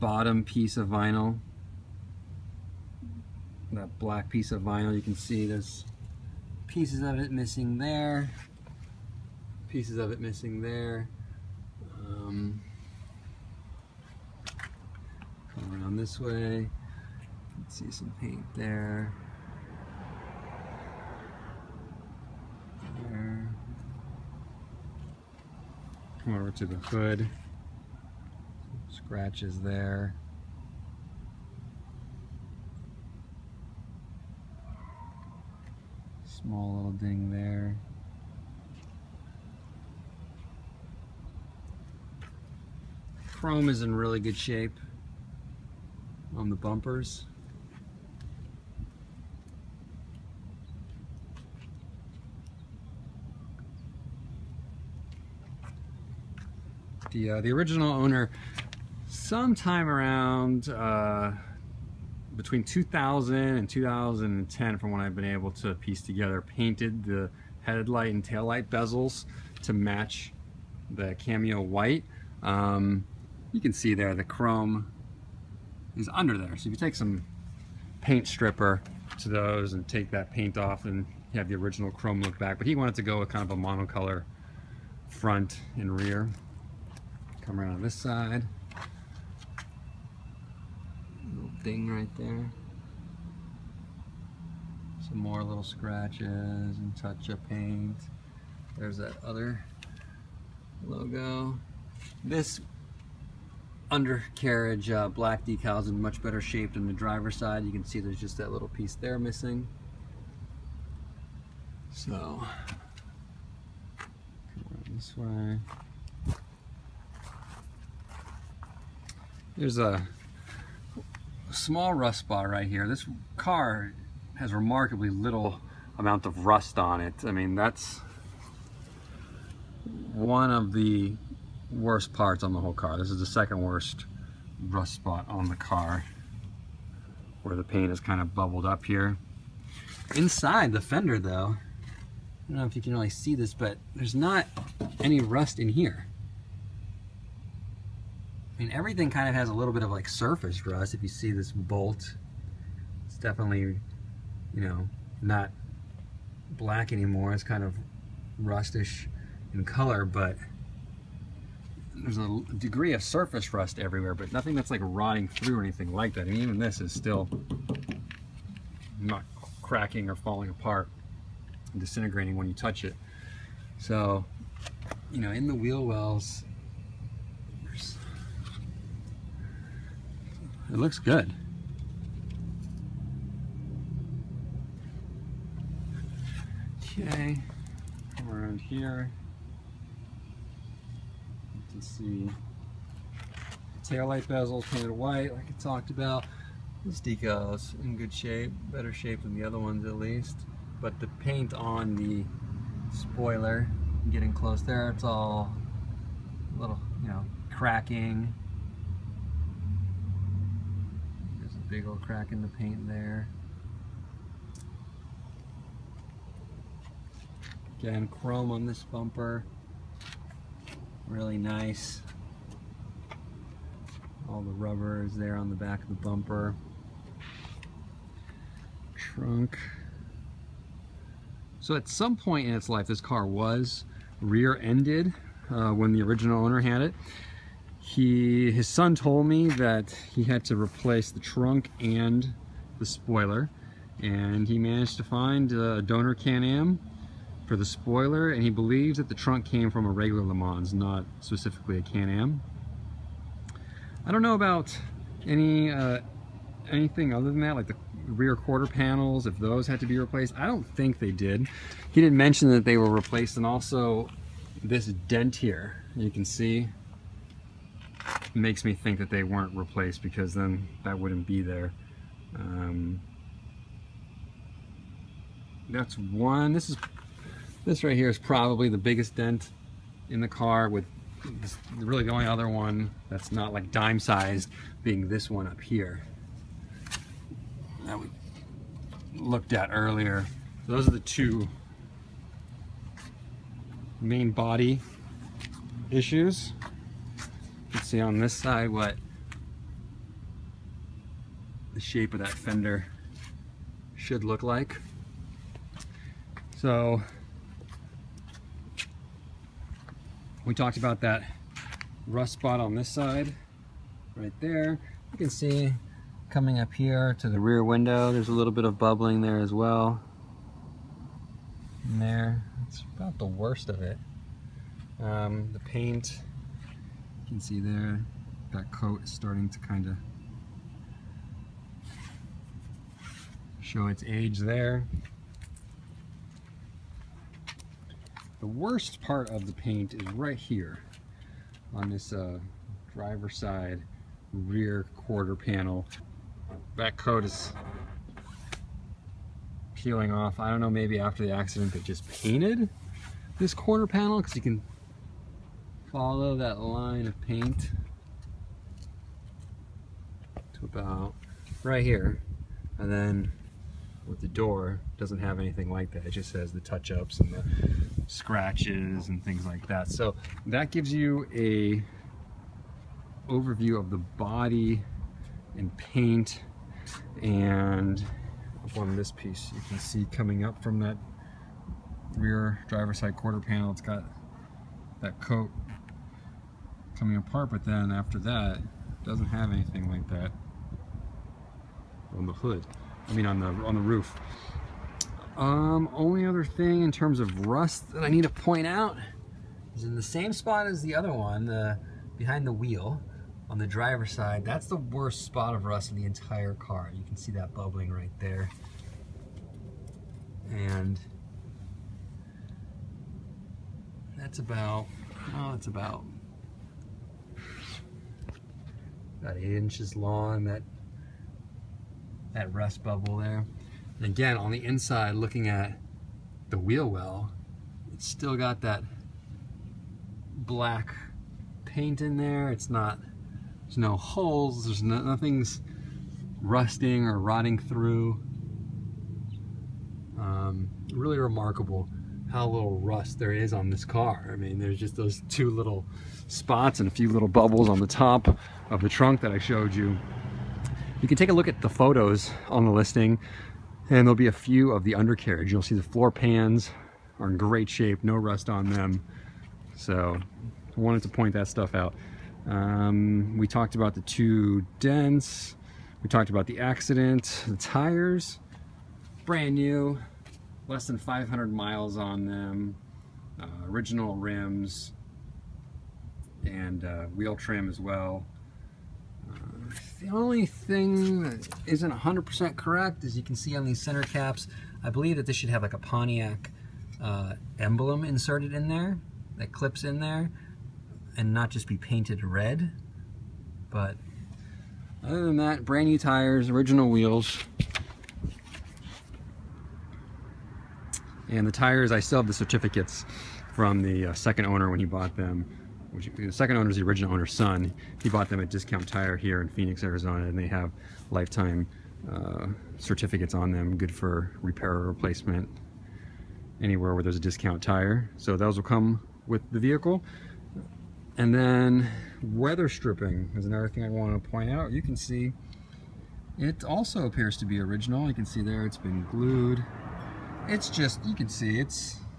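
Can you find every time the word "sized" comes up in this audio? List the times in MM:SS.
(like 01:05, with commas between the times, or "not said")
04:43.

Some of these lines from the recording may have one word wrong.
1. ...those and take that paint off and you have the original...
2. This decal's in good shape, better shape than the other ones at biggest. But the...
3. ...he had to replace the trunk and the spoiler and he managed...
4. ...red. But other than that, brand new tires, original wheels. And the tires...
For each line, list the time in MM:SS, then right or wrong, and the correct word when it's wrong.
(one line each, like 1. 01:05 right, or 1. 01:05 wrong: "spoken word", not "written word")
1. 01:19 right
2. 03:16 wrong: "least", not "biggest"
3. 04:00 right
4. 08:12 right.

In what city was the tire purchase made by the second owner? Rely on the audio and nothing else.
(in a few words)
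Phoenix.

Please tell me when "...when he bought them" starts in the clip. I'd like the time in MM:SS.
08:24.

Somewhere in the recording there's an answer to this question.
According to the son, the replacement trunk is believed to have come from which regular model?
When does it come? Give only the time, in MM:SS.
04:09.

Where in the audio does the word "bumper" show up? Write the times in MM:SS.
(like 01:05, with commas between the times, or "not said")
00:46, 03:38, 03:45.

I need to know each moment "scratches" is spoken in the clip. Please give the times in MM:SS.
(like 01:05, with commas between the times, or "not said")
00:28, 01:35, 06:08.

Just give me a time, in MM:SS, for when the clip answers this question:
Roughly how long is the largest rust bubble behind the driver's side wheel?
06:59.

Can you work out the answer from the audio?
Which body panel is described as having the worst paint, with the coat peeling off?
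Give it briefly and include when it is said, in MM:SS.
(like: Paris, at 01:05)
driver side rear quarter panel, at 05:42.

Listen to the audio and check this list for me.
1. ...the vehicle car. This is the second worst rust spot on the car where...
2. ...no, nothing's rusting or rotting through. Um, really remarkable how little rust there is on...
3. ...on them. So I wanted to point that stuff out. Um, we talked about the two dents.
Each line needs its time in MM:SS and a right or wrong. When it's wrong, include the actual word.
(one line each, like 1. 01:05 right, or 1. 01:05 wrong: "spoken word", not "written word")
1. 02:12 wrong: "whole", not "vehicle"
2. 07:14 right
3. 07:38 right.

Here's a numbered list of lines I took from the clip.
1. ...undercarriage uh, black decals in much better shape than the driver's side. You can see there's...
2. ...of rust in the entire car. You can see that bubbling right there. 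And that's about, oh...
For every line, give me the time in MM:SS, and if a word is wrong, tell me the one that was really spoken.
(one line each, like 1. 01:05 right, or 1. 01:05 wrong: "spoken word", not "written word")
1. 01:43 right
2. 06:45 right.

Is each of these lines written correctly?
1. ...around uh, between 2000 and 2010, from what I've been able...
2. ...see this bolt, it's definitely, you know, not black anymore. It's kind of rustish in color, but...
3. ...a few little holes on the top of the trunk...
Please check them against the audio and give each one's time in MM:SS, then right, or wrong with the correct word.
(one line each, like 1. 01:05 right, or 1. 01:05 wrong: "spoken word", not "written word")
1. 00:59 right
2. 02:31 right
3. 07:26 wrong: "bubbles", not "holes".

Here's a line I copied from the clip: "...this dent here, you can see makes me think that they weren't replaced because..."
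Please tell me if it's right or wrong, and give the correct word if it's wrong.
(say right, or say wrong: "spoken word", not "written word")
right.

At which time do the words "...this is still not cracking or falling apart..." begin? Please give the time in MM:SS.
02:46.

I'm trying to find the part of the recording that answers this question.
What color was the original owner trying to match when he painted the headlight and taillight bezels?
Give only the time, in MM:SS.
01:11.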